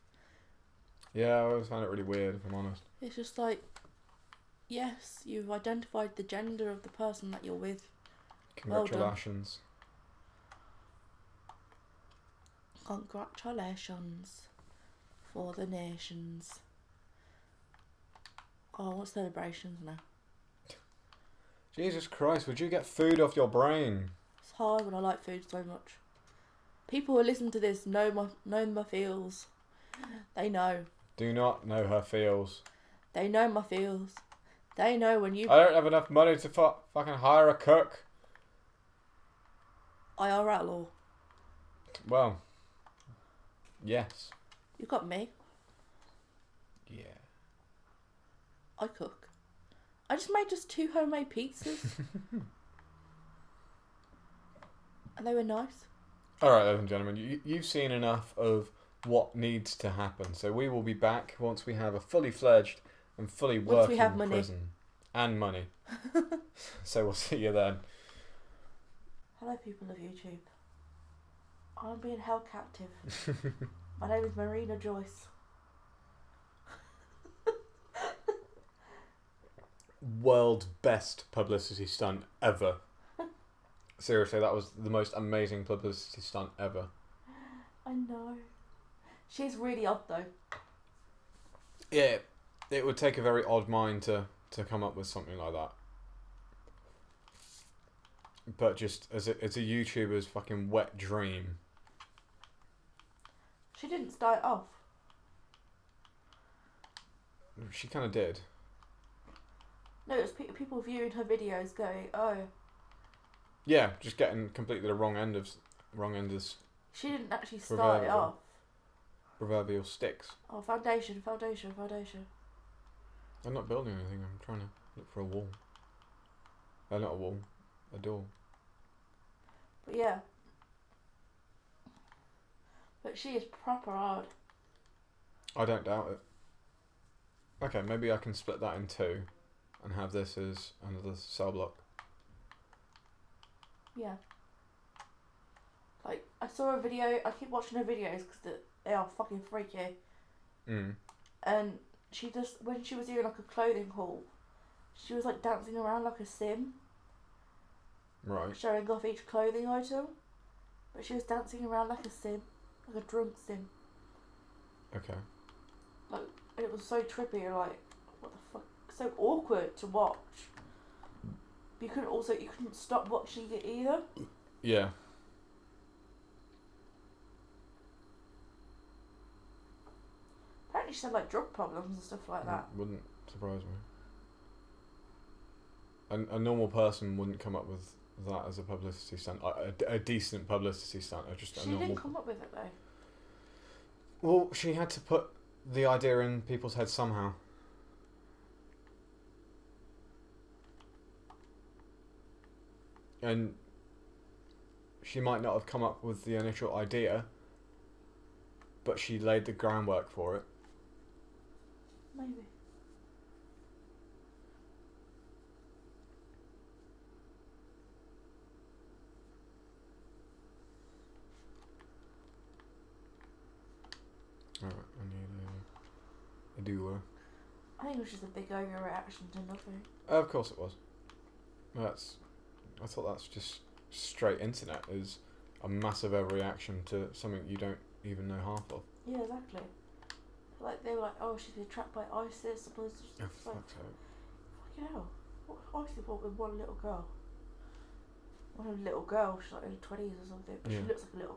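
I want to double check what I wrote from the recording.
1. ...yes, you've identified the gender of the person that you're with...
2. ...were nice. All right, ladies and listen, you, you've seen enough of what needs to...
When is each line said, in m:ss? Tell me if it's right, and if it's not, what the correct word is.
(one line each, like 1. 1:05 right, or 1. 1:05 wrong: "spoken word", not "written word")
1. 0:04 right
2. 0:55 wrong: "gentlemen", not "listen".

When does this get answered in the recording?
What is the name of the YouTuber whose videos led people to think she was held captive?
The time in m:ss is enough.
1:14.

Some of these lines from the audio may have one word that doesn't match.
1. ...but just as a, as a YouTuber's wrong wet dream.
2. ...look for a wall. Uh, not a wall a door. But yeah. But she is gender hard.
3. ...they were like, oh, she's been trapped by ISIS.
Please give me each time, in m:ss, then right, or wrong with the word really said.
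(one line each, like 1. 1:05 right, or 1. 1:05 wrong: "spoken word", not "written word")
1. 1:38 wrong: "fucking", not "wrong"
2. 2:04 wrong: "proper", not "gender"
3. 4:00 right.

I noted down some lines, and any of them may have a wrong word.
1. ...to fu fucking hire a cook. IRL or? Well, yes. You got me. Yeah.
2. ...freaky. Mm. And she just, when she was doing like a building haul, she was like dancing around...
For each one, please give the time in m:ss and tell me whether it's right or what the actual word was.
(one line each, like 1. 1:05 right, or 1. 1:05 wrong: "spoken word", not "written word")
1. 0:36 right
2. 2:29 wrong: "clothing", not "building".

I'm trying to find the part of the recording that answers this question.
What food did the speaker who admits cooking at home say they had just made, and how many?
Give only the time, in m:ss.
0:50.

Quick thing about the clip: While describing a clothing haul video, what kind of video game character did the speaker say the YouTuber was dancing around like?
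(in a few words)
A drunk sim.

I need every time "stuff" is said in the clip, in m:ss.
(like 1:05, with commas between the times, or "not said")
3:02.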